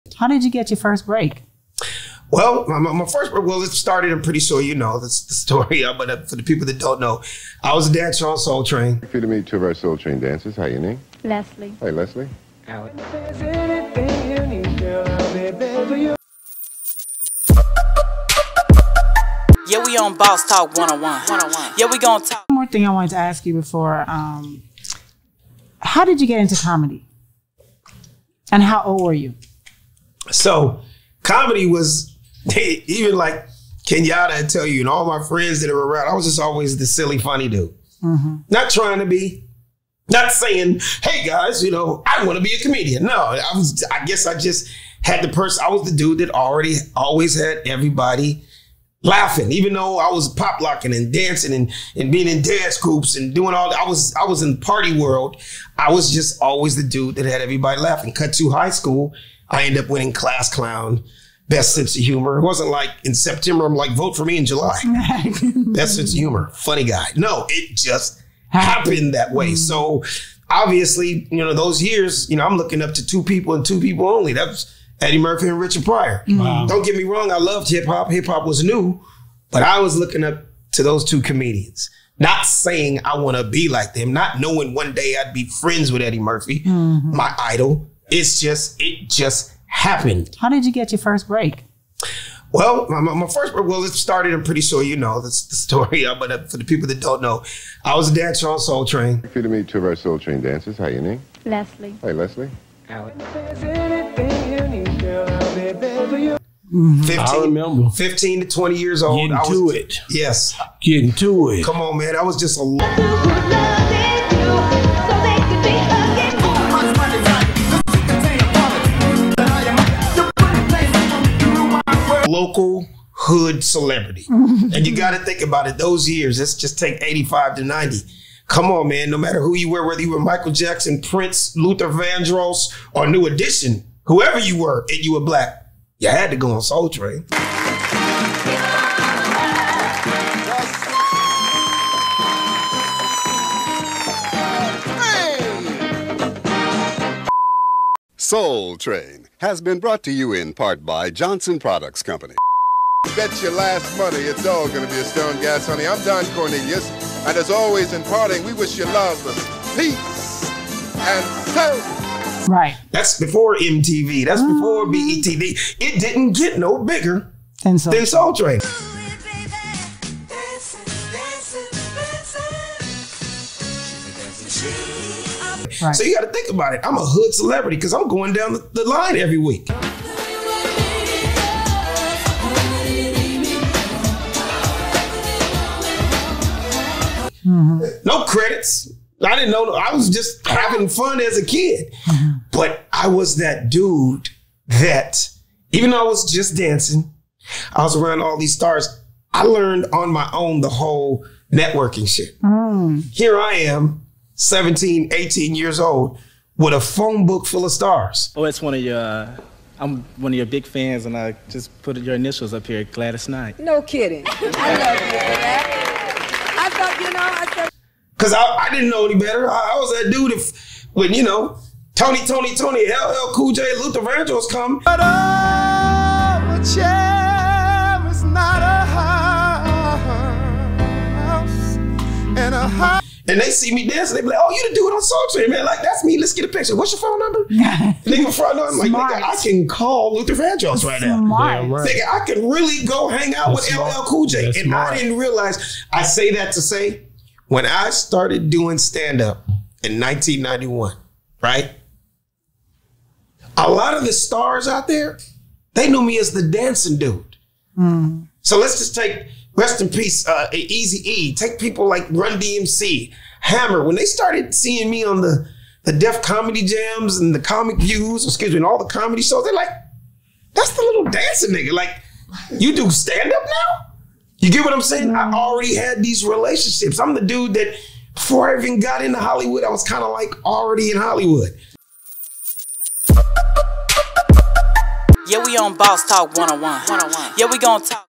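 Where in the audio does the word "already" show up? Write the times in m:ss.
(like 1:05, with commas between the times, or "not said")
0:46, 4:35, 4:40.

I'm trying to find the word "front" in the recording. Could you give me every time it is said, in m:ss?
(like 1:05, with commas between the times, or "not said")
3:58.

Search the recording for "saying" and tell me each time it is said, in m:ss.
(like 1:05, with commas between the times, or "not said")
0:40, 1:22, 4:34.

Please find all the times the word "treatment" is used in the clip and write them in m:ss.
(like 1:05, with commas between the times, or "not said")
not said.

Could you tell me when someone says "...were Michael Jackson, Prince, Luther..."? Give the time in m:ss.
2:10.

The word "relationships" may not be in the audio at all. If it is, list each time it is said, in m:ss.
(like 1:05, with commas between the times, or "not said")
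4:36.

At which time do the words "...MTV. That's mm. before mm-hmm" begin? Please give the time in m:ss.
2:43.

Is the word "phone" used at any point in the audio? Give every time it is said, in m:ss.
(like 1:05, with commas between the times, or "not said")
3:26, 3:57.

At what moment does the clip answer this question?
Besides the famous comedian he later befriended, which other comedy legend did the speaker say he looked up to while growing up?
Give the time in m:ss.
1:15.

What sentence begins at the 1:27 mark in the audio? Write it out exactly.
my idol, it's just it just happened.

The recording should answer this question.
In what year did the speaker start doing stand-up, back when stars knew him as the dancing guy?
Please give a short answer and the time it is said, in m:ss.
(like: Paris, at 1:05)
1991, at 4:09.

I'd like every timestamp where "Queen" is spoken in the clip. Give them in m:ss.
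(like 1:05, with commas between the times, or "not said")
not said.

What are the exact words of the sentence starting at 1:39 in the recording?
Good to meet two of our Soul Train dancers.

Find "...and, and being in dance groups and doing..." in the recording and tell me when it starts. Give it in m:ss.
0:51.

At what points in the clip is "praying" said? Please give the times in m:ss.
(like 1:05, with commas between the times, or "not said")
not said.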